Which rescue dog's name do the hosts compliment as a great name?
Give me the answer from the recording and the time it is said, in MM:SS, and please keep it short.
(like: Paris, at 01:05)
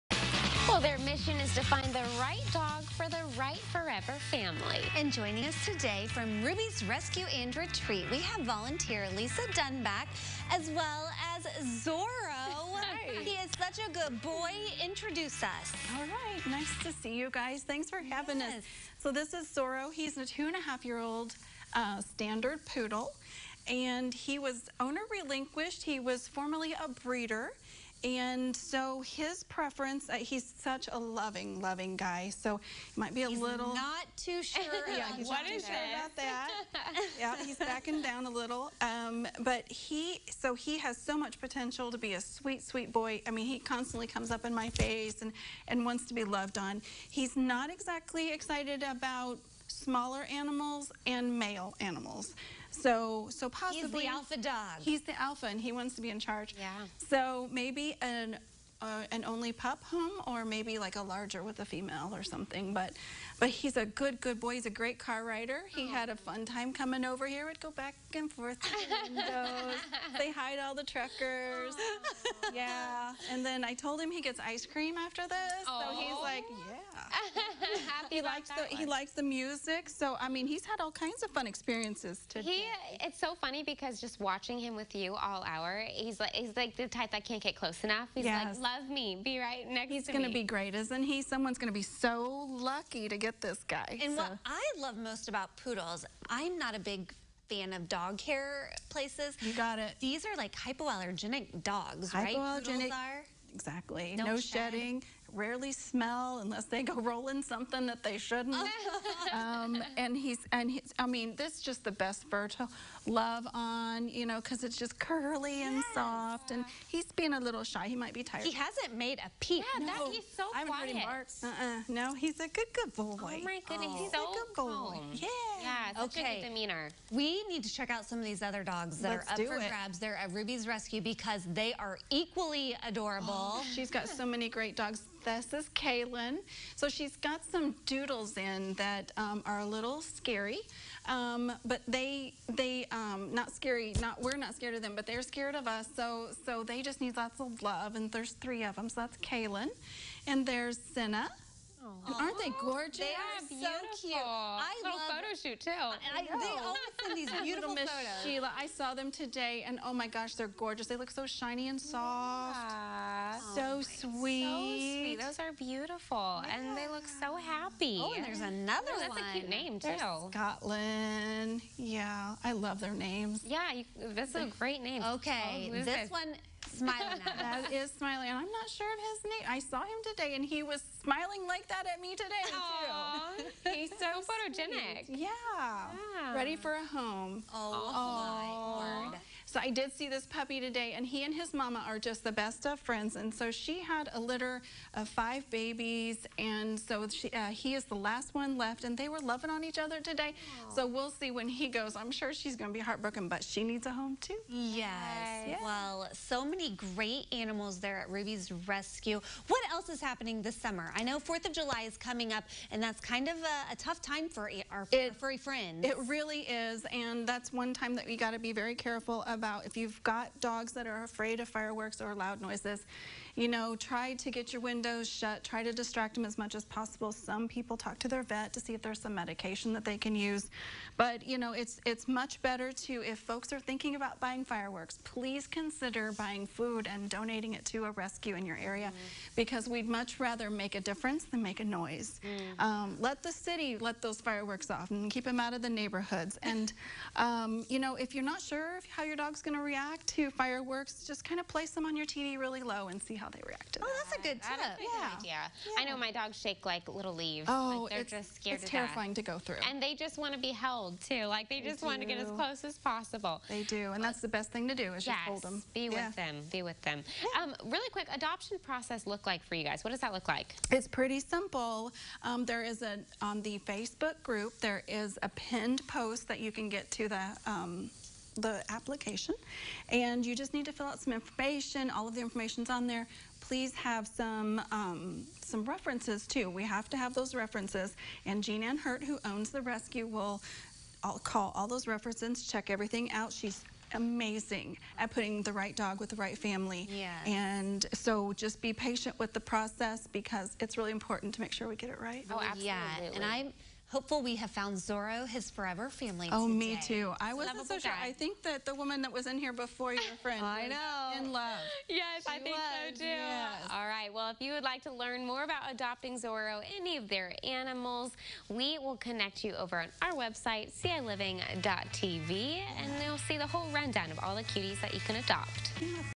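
Scotland, at 02:50.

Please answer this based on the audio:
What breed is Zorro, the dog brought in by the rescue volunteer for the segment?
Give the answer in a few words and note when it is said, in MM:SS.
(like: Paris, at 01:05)
Standard poodle, at 00:22.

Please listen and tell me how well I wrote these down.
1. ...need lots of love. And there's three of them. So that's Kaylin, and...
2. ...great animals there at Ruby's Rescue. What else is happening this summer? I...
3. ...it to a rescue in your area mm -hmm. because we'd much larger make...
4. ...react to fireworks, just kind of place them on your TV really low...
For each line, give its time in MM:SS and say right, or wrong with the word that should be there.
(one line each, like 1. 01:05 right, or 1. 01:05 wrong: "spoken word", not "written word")
1. 02:27 right
2. 03:26 right
3. 03:57 wrong: "rather", not "larger"
4. 04:09 right.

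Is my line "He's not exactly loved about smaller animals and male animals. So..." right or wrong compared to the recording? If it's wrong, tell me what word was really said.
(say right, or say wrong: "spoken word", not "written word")
wrong: "excited", not "loved".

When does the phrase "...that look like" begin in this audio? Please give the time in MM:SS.
04:29.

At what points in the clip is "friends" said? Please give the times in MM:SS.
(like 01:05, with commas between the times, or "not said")
03:12, 03:35, 05:10.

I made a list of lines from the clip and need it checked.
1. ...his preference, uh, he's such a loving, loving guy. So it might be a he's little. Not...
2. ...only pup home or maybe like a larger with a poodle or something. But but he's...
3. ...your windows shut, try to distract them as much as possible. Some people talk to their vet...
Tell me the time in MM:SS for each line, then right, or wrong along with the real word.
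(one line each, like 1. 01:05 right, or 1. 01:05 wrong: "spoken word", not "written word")
1. 00:29 right
2. 00:59 wrong: "female", not "poodle"
3. 03:44 right.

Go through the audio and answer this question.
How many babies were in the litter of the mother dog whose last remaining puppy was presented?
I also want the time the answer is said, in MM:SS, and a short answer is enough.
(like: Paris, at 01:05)
5, at 03:15.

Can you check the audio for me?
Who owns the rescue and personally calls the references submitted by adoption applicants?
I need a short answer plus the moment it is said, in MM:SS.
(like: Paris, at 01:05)
Jean Ann Hurt, at 04:48.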